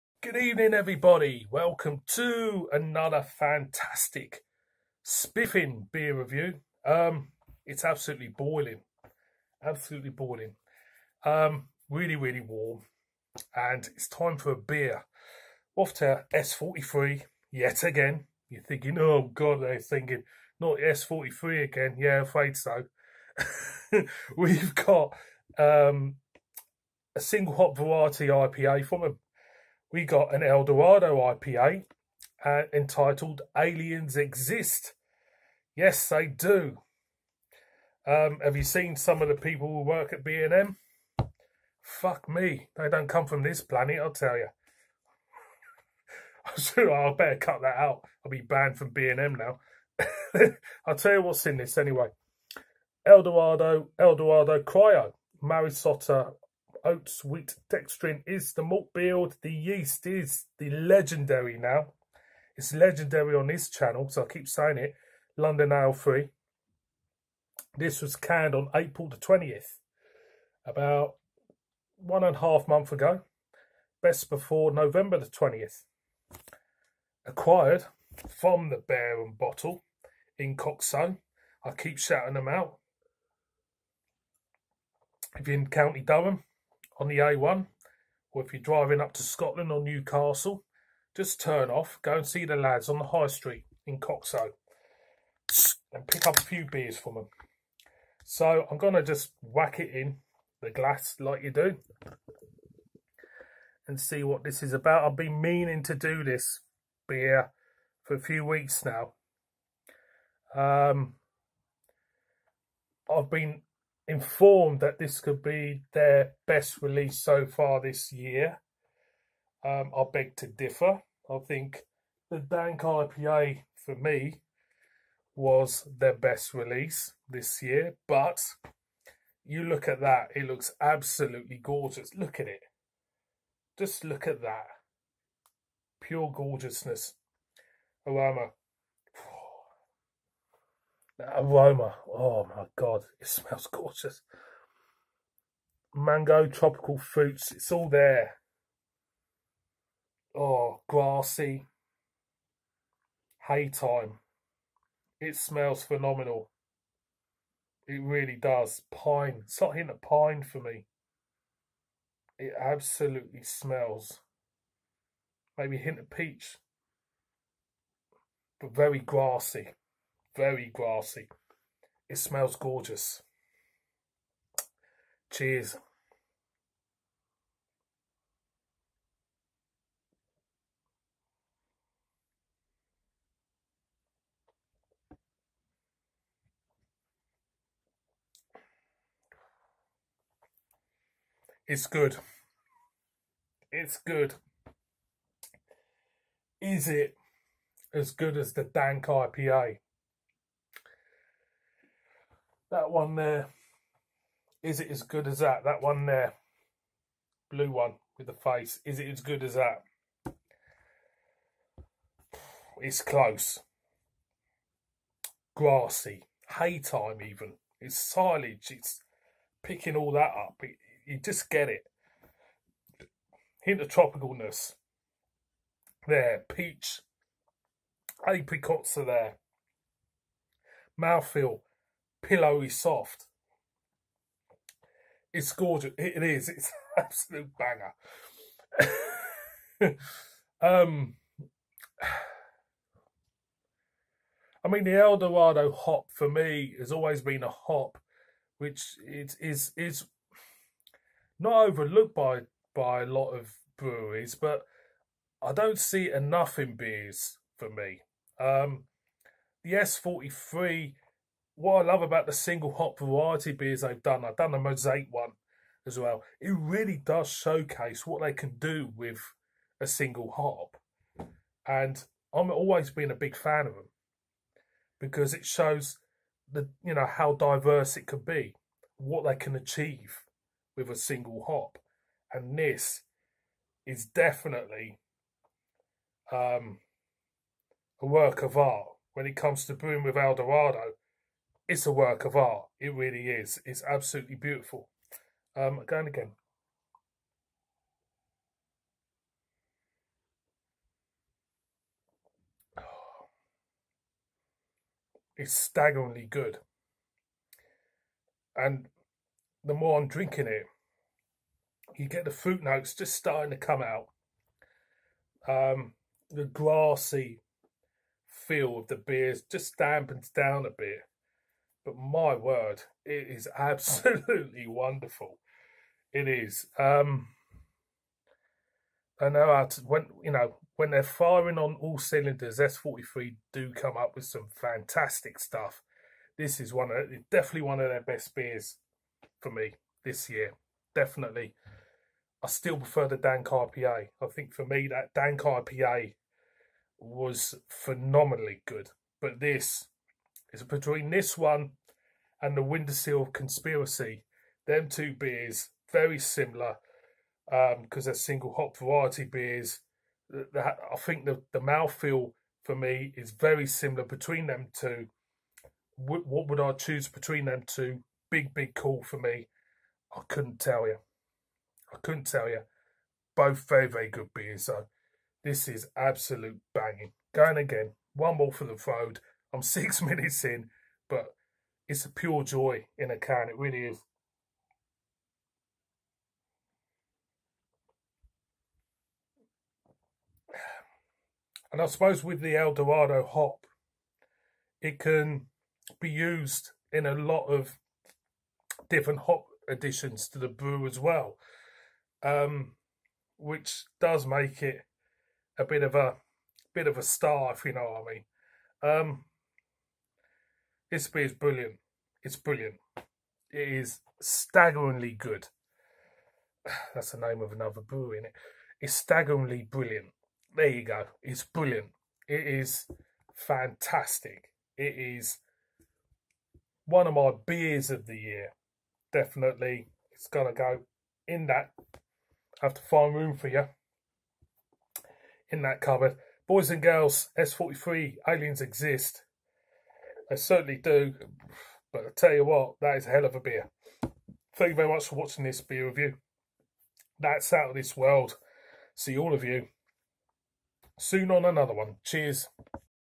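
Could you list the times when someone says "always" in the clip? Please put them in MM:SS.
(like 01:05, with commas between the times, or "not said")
04:06, 04:32.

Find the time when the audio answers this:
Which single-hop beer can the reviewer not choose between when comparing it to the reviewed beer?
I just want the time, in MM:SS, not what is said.
05:52.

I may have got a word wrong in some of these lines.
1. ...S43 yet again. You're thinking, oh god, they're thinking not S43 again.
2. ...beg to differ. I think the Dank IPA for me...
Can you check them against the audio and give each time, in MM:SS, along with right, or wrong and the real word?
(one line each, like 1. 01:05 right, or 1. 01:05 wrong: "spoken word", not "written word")
1. 00:16 right
2. 02:00 right.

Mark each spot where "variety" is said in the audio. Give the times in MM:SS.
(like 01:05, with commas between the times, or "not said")
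00:27, 04:22, 05:58.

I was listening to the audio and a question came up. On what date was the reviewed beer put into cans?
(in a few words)
April 20th.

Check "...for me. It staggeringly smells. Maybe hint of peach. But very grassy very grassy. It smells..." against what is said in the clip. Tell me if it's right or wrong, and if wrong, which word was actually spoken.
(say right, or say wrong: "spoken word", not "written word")
wrong: "absolutely", not "staggeringly".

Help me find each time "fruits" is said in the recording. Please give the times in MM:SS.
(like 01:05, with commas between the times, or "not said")
02:26, 05:12.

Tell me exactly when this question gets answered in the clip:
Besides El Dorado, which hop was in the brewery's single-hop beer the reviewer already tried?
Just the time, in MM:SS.
04:24.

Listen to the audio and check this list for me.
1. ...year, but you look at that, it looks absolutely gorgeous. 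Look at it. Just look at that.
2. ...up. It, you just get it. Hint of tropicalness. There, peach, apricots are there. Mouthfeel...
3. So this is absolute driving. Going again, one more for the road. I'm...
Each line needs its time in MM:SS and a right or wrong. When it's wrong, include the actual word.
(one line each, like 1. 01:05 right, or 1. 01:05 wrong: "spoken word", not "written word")
1. 02:07 right
2. 03:40 right
3. 06:14 wrong: "banging", not "driving".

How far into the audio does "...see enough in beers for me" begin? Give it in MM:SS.
04:15.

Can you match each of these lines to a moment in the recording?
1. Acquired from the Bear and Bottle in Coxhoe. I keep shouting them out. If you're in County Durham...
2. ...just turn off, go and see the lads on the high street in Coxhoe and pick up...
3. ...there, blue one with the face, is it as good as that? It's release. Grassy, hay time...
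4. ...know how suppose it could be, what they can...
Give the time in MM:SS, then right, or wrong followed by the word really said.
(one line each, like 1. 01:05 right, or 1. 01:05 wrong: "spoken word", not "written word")
1. 01:17 right
2. 01:31 right
3. 03:26 wrong: "close", not "release"
4. 04:36 wrong: "diverse", not "suppose".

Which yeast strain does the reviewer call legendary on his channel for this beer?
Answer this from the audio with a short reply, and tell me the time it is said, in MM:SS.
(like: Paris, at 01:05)
London Ale 3, at 01:05.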